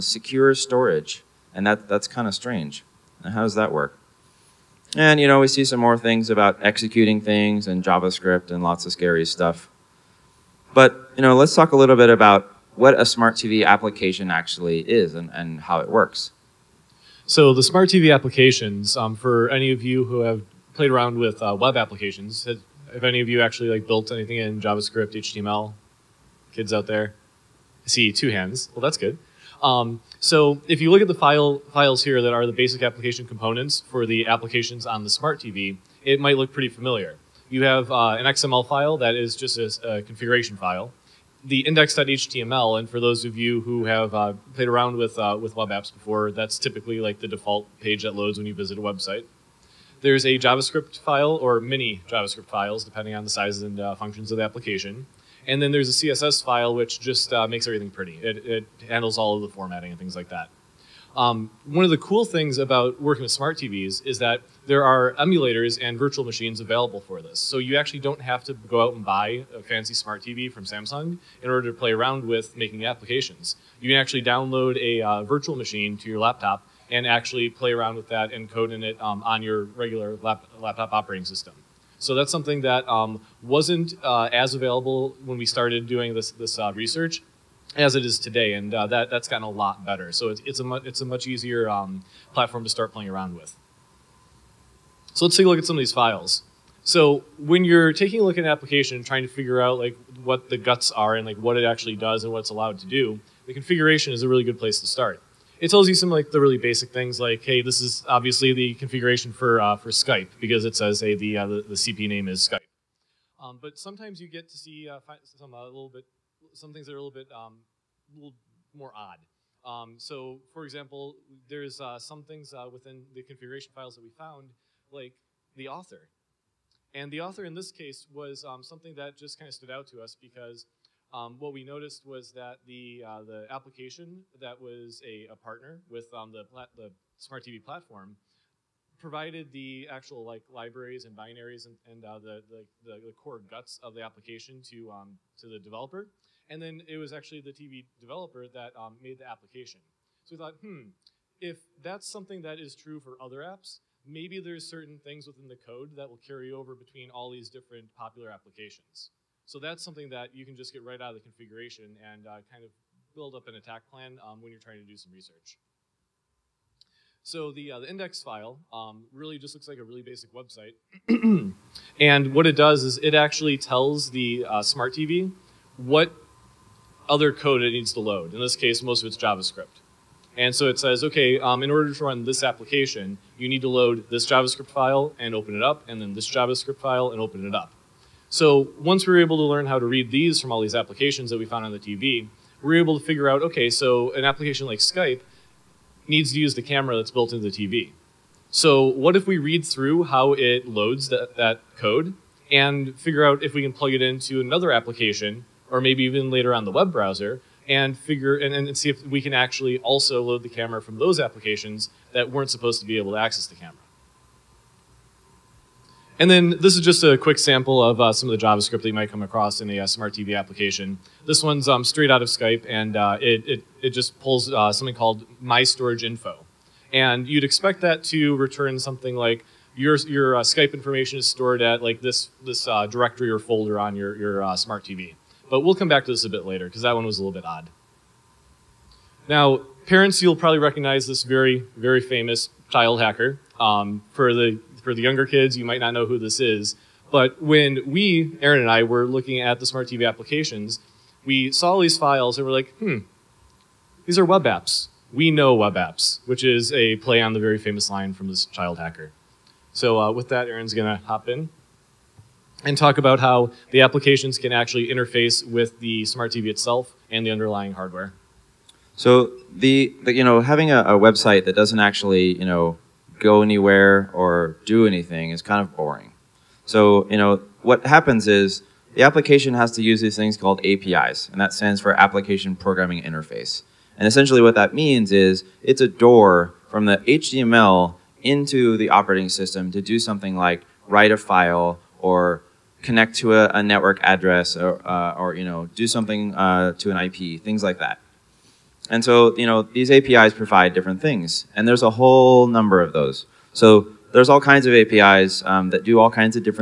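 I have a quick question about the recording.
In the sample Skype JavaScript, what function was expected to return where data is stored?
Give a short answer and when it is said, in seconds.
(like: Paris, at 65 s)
My Storage Info, at 225 s.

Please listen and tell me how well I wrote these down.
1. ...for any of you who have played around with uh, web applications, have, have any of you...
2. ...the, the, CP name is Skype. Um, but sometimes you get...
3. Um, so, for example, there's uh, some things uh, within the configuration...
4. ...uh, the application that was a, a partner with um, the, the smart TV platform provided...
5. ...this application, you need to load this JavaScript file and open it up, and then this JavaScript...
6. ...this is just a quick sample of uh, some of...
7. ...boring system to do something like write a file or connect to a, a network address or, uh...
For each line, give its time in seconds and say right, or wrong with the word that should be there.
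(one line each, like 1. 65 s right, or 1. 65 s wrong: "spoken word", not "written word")
1. 19 s right
2. 111 s right
3. 119 s right
4. 133 s right
5. 182 s right
6. 216 s right
7. 288 s wrong: "operating", not "boring".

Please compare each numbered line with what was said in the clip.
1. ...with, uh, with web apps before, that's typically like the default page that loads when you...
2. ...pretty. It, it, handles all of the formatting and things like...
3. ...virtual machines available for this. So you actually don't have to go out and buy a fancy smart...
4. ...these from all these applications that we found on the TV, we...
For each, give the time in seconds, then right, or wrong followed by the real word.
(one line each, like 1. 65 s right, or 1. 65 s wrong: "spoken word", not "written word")
1. 44 s right
2. 57 s right
3. 65 s right
4. 190 s right.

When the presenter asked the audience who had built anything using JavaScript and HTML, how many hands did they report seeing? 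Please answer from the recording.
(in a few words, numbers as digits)
2.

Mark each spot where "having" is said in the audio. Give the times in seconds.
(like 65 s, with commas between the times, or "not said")
270 s.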